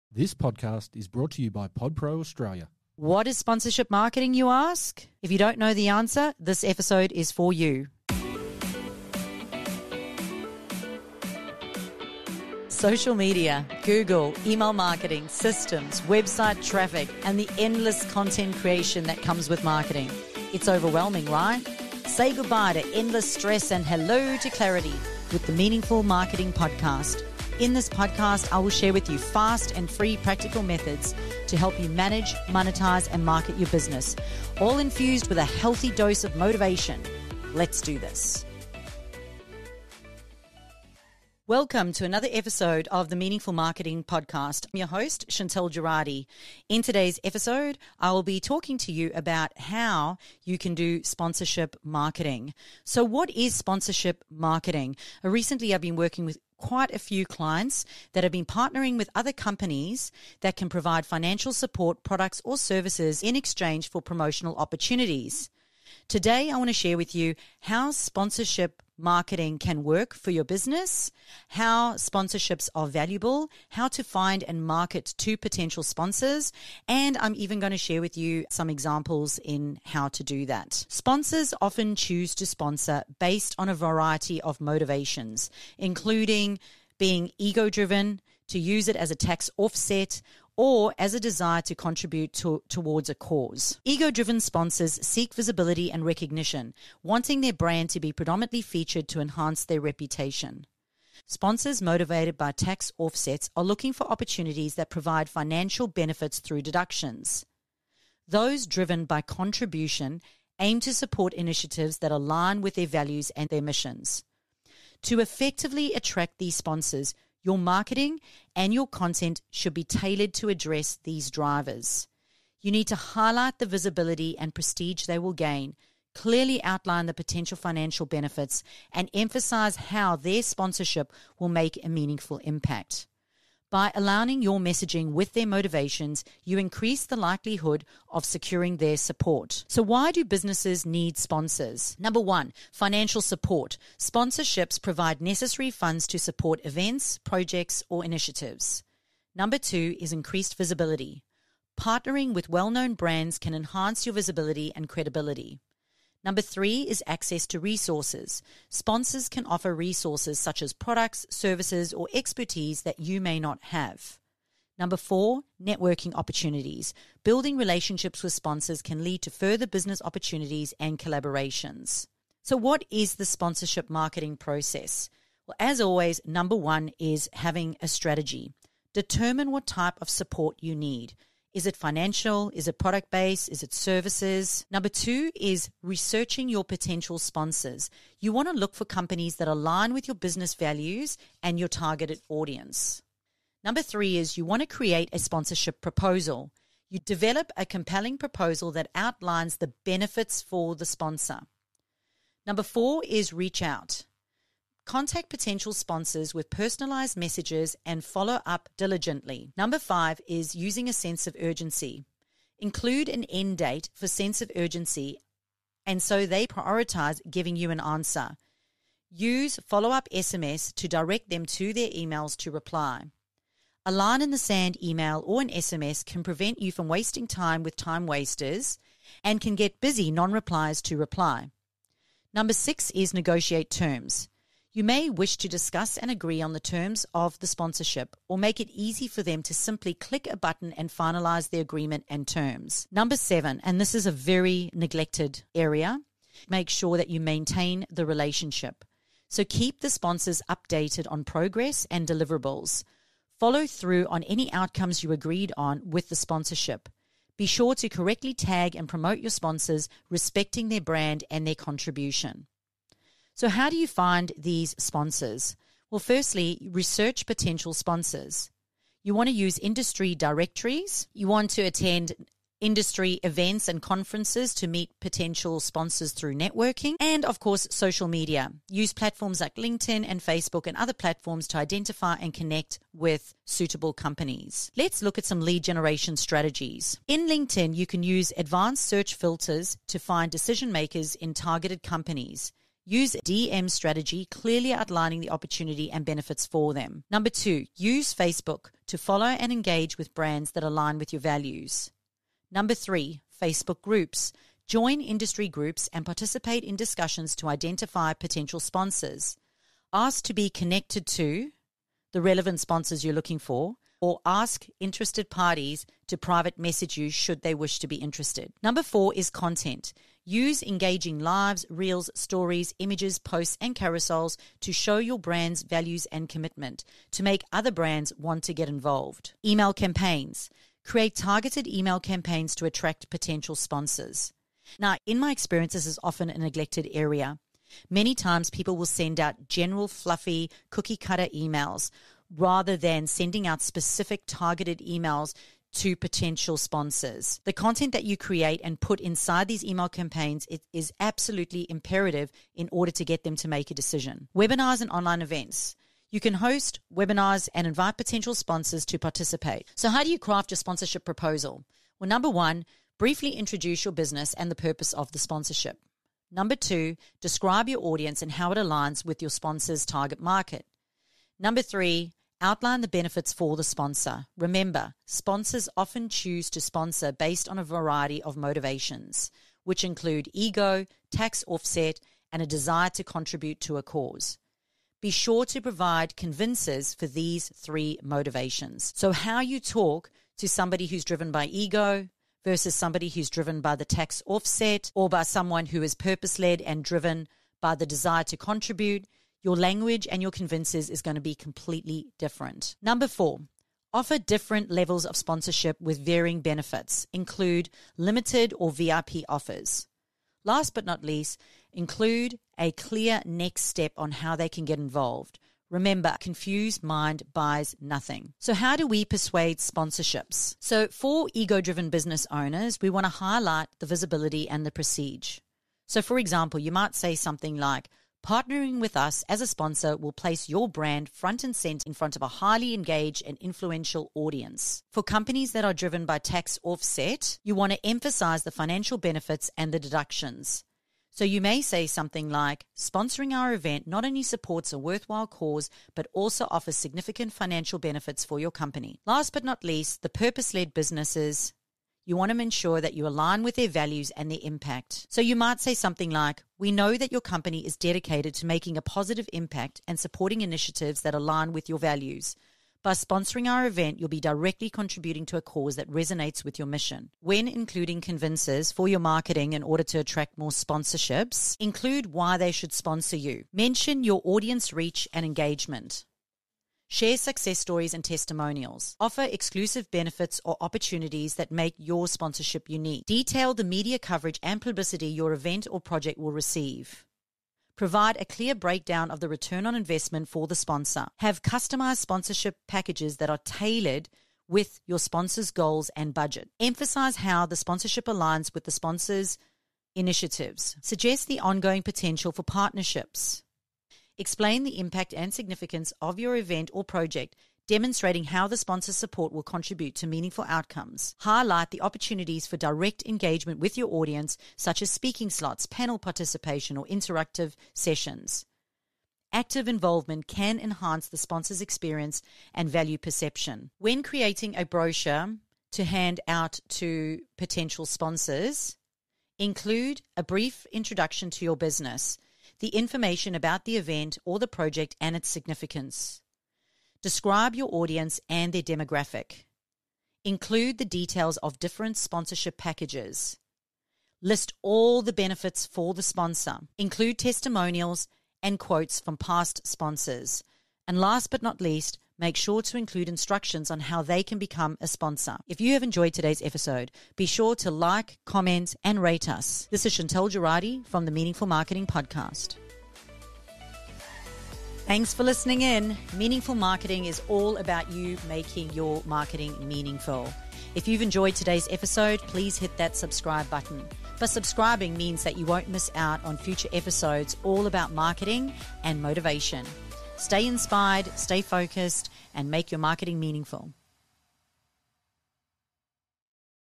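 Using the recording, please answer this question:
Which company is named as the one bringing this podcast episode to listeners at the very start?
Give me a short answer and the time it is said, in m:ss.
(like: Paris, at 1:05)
PodPro Australia, at 0:01.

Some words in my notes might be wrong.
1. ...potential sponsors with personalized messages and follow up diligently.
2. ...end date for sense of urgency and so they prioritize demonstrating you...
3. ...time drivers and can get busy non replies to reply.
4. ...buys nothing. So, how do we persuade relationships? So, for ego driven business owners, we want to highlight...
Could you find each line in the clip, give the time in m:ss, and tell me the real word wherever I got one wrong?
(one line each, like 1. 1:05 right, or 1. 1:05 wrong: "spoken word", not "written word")
1. 3:25 right
2. 3:33 wrong: "giving", not "demonstrating"
3. 3:47 wrong: "wasters", not "drivers"
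4. 6:57 wrong: "sponsorships", not "relationships".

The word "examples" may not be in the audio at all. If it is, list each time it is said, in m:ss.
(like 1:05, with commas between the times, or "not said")
1:18, 7:06.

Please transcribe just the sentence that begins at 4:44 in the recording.
Let's look at some lead generation strategies.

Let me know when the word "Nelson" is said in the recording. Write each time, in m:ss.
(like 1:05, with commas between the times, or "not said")
not said.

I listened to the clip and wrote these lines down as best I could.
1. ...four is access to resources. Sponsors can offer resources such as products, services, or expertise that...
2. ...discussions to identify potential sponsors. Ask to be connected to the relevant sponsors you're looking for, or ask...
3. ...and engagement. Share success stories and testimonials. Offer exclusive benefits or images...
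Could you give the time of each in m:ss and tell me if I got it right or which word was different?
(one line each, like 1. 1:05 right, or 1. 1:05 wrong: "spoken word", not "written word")
1. 2:36 wrong: "three", not "four"
2. 5:06 right
3. 7:55 wrong: "opportunities", not "images".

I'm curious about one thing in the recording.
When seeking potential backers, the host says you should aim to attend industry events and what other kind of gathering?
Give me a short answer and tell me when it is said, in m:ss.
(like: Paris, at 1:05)
Conferences, at 4:33.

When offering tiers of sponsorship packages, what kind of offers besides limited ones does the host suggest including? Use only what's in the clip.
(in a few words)
VIP offers.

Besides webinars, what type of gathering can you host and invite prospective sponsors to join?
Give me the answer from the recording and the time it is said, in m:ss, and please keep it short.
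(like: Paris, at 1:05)
Online events, at 5:54.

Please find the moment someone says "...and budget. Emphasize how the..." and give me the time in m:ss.
8:15.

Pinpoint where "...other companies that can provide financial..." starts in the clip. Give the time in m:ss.
0:59.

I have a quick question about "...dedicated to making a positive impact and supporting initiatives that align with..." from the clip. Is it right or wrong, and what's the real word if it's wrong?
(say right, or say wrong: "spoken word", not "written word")
right.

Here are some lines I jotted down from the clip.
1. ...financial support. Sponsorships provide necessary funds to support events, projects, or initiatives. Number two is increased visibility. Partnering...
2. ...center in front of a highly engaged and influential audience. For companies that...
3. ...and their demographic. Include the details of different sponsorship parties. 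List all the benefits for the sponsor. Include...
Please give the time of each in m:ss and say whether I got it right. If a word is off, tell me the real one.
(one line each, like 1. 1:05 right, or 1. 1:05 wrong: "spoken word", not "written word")
1. 2:22 right
2. 7:11 right
3. 8:58 wrong: "packages", not "parties".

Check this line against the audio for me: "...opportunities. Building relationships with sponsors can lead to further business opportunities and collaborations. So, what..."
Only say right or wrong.
right.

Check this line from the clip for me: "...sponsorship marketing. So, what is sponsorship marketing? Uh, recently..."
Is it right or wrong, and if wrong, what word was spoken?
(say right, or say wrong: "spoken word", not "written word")
right.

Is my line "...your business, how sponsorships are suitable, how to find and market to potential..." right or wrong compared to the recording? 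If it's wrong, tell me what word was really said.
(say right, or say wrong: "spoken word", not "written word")
wrong: "valuable", not "suitable".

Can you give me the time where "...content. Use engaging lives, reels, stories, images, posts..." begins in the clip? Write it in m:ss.
5:19.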